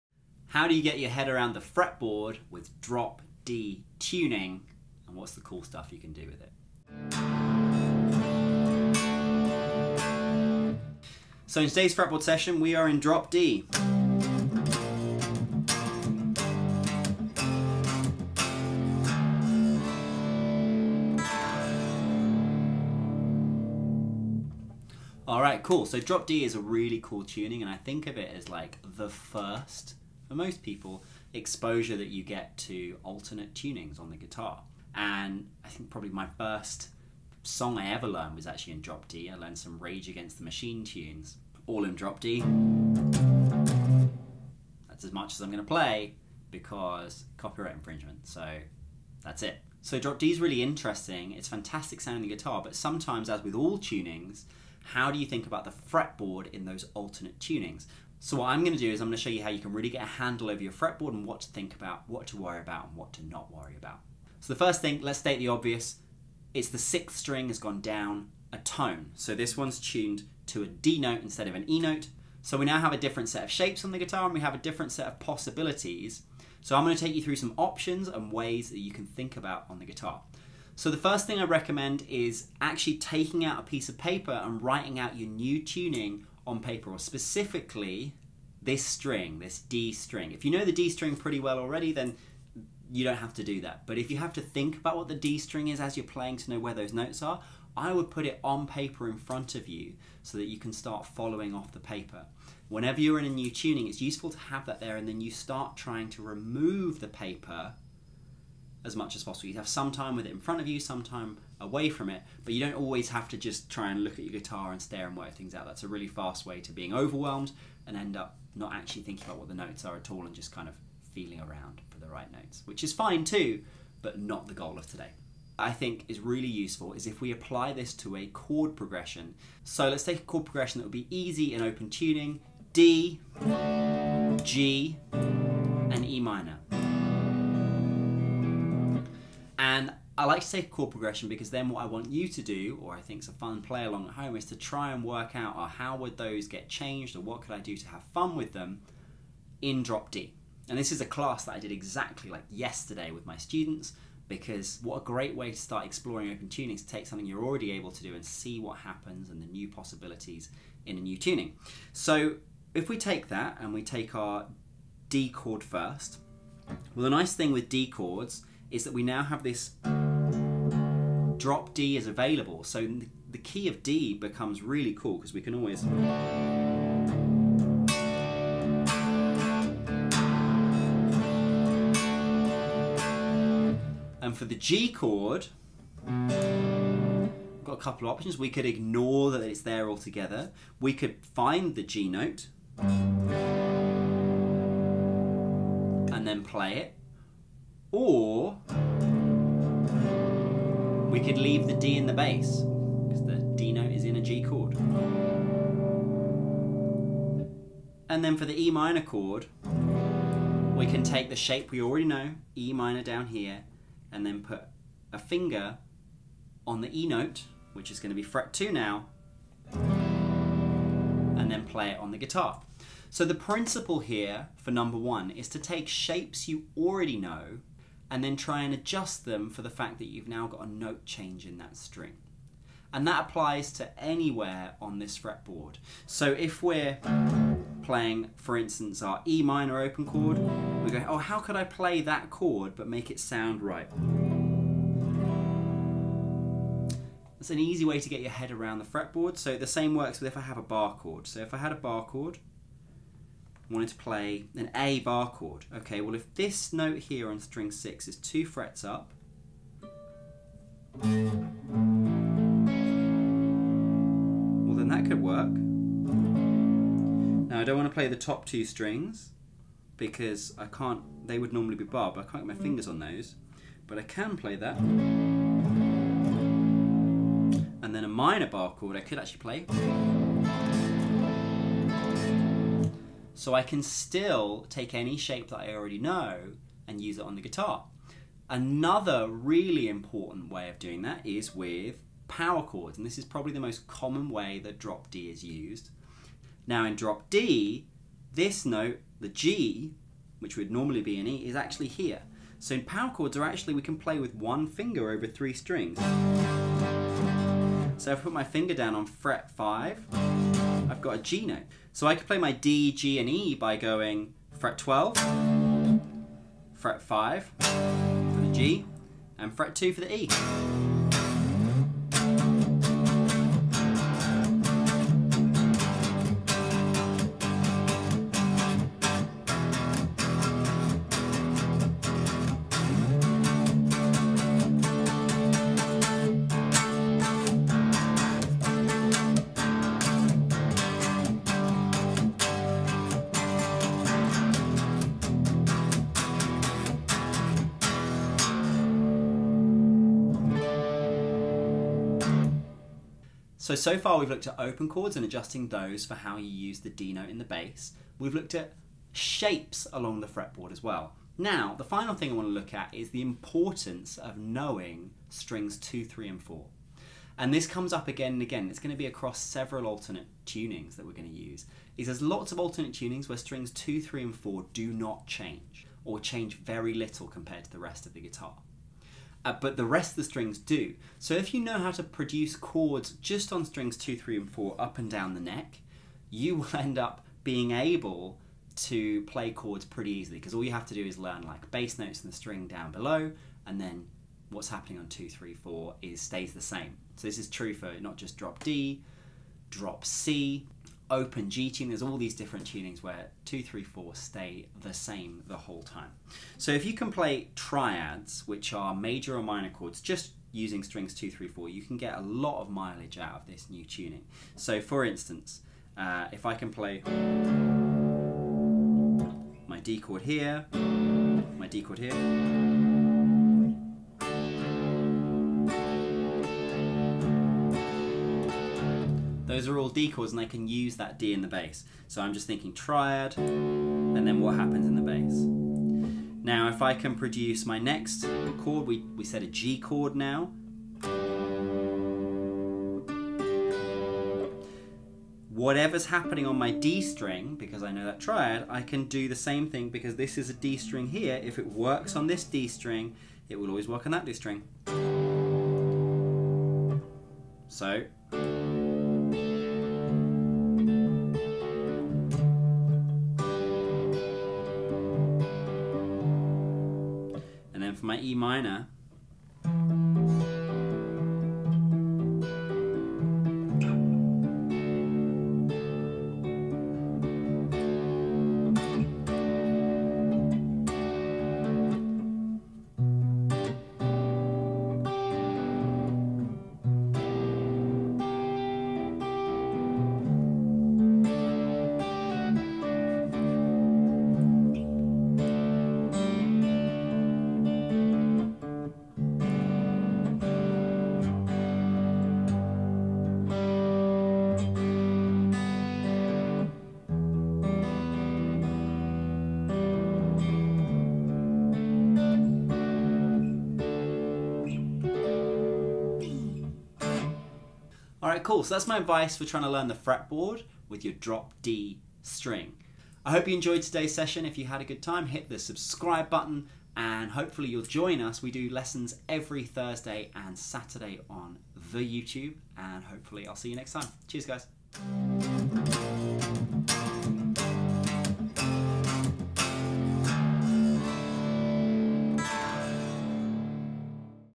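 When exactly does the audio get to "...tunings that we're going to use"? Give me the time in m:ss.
6:10.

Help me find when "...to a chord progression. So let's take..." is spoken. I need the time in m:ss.
2:07.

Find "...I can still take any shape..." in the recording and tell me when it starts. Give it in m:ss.
4:43.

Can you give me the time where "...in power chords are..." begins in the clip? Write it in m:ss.
5:02.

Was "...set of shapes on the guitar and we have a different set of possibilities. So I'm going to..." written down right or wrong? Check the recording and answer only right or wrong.
right.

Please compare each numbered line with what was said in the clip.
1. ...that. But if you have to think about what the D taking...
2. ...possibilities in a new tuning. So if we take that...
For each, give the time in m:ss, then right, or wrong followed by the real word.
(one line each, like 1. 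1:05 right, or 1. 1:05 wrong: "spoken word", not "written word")
1. 1:33 wrong: "string", not "taking"
2. 2:39 right.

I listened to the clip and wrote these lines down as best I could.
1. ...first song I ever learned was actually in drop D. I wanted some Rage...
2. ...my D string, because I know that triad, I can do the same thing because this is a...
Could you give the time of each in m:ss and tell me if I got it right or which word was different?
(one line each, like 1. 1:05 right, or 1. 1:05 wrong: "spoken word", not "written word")
1. 0:36 wrong: "learned", not "wanted"
2. 7:26 right.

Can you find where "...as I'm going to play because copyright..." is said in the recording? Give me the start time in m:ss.
0:45.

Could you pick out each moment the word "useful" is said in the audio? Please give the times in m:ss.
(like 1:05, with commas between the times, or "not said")
1:44, 2:06.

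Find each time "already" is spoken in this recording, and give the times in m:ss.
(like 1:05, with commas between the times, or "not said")
1:31, 2:37, 3:31, 3:46, 4:45.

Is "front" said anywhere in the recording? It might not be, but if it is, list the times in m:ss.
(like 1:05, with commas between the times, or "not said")
1:39, 1:50.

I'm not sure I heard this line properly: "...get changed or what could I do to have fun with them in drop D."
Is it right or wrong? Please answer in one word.
right.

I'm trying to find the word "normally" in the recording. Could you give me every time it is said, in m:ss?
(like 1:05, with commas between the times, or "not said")
4:31, 5:00.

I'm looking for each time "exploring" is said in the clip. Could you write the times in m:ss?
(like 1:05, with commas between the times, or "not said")
2:35.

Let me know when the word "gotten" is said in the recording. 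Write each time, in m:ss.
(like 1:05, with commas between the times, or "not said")
not said.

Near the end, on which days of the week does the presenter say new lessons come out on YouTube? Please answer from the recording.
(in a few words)
Thursday and Saturday.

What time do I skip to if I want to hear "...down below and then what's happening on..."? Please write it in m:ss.
6:32.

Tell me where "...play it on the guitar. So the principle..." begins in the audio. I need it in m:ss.
3:41.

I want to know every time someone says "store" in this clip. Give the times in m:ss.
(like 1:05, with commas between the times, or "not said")
not said.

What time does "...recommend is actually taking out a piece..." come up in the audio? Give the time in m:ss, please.
1:21.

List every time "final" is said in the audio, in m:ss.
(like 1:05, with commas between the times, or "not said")
6:01.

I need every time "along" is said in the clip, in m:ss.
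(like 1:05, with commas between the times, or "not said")
2:23, 5:59.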